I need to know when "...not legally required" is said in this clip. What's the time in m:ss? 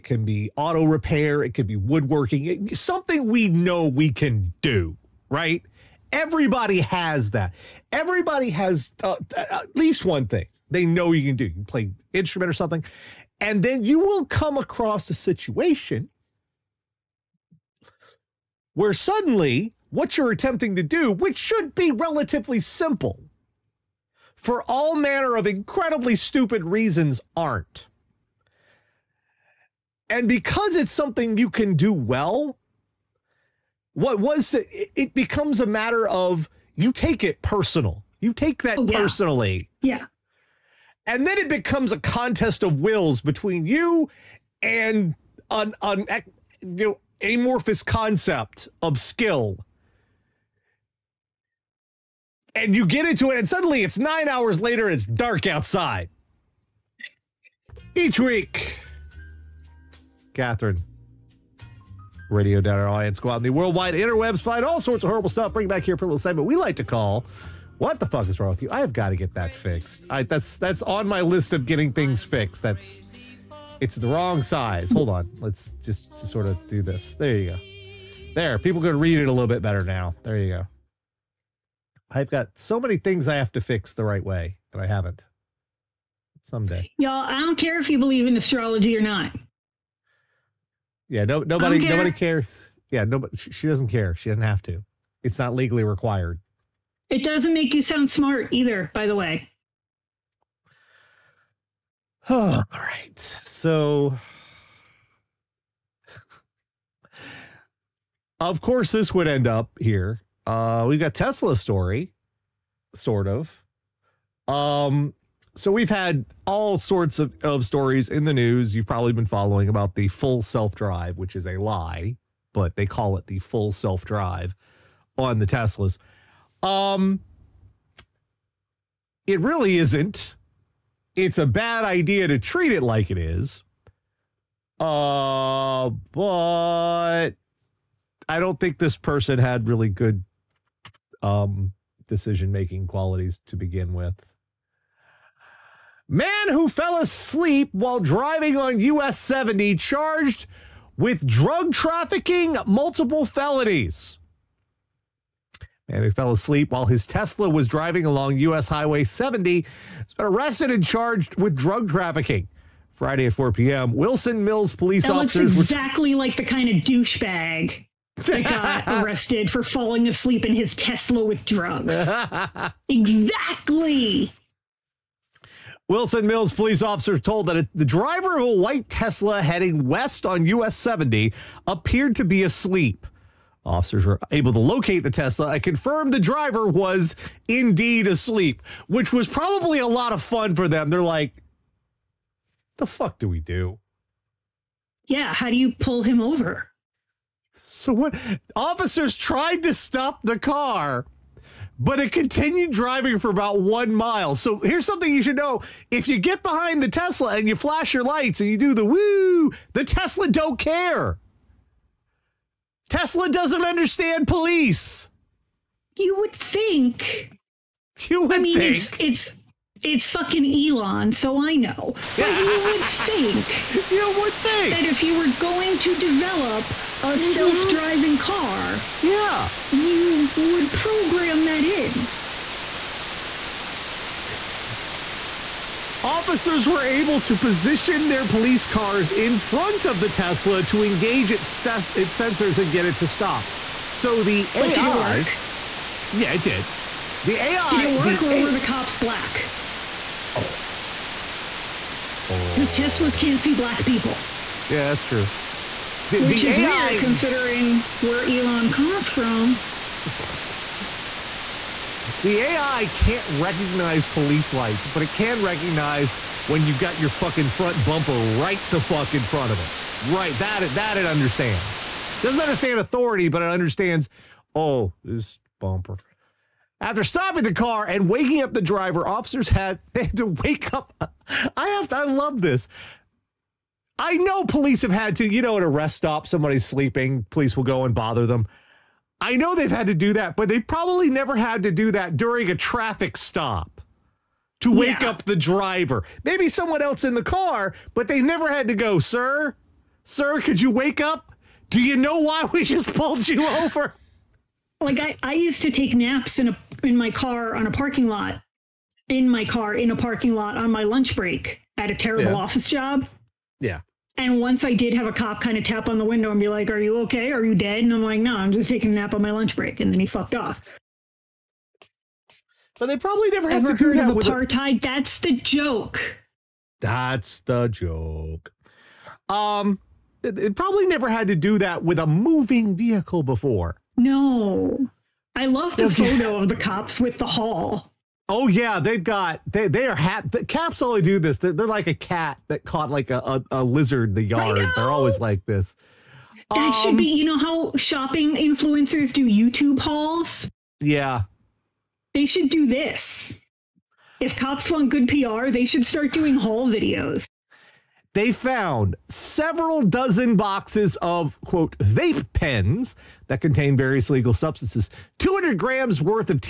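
1:35.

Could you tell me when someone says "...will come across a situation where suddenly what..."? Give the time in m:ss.
0:13.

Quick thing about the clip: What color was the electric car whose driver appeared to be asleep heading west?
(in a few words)
White.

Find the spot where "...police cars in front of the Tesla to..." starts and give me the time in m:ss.
3:58.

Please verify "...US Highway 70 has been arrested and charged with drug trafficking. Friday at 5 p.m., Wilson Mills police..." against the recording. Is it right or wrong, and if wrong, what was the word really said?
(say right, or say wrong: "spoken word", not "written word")
wrong: "4", not "5".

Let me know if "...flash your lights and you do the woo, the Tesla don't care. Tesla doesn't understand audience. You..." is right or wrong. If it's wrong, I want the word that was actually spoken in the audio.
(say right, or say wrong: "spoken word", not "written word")
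wrong: "police", not "audience".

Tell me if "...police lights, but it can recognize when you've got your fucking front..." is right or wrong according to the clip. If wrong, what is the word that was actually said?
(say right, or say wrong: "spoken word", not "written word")
right.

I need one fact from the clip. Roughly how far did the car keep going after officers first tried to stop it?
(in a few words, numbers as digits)
About 1 mile.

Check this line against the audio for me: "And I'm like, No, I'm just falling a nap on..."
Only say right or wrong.
wrong.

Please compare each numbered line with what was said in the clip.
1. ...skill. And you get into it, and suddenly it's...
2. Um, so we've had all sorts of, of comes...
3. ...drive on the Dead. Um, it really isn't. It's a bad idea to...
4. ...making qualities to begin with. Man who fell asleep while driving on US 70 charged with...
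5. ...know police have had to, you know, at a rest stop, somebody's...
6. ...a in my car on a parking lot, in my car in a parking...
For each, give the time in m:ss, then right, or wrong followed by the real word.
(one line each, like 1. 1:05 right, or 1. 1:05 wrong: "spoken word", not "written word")
1. 0:48 right
2. 1:54 wrong: "stories", not "comes"
3. 2:04 wrong: "Teslas", not "Dead"
4. 2:22 right
5. 4:44 right
6. 5:06 right.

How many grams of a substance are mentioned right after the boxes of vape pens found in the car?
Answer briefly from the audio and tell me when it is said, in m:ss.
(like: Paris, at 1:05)
200 grams, at 6:05.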